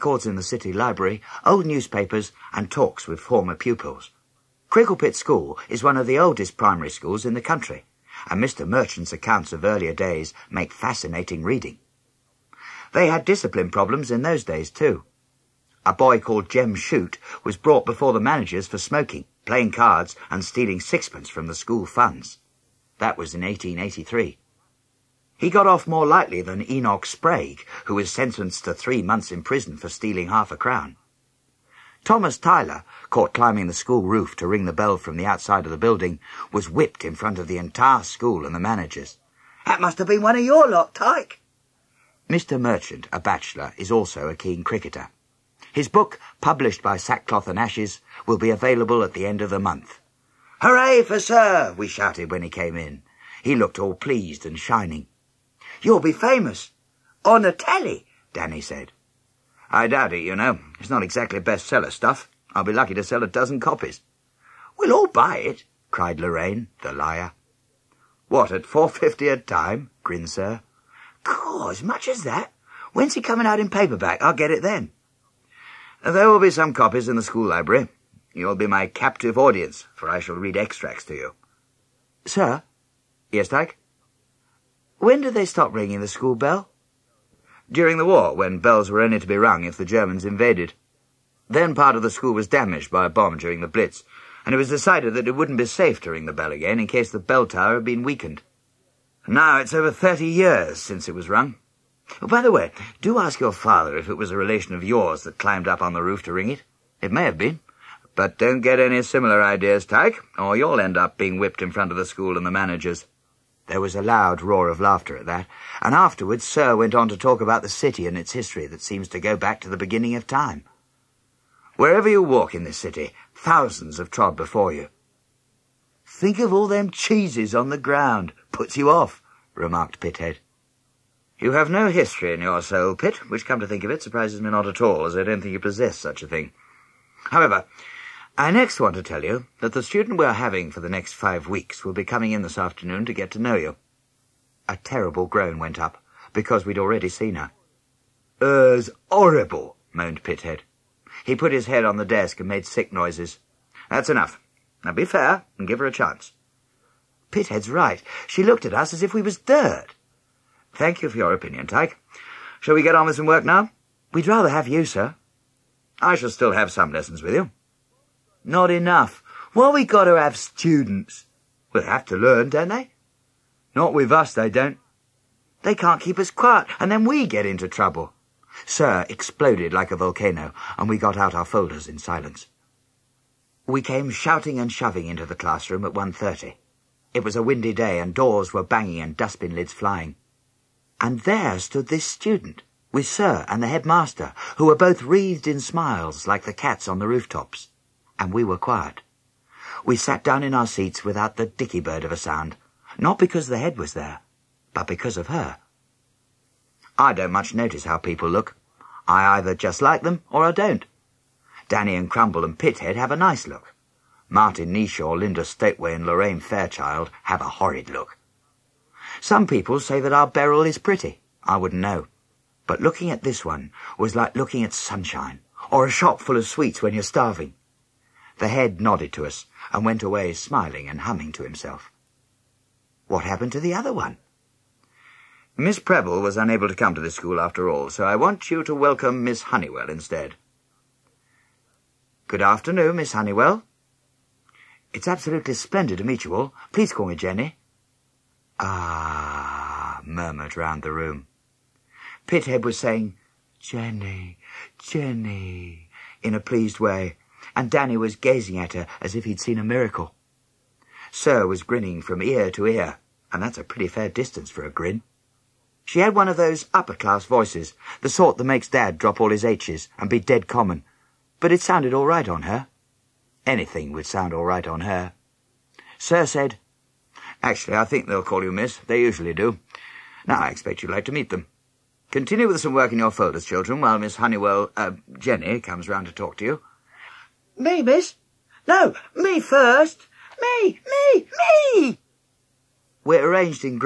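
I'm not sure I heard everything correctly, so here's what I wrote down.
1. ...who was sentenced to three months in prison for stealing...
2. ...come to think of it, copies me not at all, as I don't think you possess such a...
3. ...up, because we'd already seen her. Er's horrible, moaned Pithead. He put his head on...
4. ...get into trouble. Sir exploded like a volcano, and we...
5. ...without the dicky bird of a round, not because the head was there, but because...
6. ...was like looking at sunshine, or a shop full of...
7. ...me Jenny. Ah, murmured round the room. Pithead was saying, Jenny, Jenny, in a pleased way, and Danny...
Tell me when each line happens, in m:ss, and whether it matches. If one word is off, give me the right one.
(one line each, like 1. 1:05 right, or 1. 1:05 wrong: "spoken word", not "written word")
1. 0:27 right
2. 2:13 wrong: "surprises", not "copies"
3. 2:25 right
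4. 2:57 right
5. 3:21 wrong: "sound", not "round"
6. 3:43 right
7. 4:07 right.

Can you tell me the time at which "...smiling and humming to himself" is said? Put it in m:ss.
3:50.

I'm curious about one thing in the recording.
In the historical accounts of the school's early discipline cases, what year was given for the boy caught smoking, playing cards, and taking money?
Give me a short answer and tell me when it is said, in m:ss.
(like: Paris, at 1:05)
1883, at 0:23.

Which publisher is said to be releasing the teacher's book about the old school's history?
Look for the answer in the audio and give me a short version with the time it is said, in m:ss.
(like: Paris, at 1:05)
Sackcloth and Ashes, at 0:46.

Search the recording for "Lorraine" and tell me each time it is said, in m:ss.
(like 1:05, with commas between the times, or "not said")
1:06, 3:36.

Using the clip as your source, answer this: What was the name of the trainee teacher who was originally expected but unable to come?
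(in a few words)
Miss Preble.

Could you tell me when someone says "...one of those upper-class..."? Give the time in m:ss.
4:26.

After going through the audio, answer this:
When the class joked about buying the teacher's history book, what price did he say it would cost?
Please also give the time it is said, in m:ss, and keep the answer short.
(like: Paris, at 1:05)
4.50, at 1:08.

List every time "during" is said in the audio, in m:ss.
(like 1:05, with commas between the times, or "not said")
1:27, 1:33.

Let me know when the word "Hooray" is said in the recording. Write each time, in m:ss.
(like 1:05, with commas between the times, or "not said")
0:50.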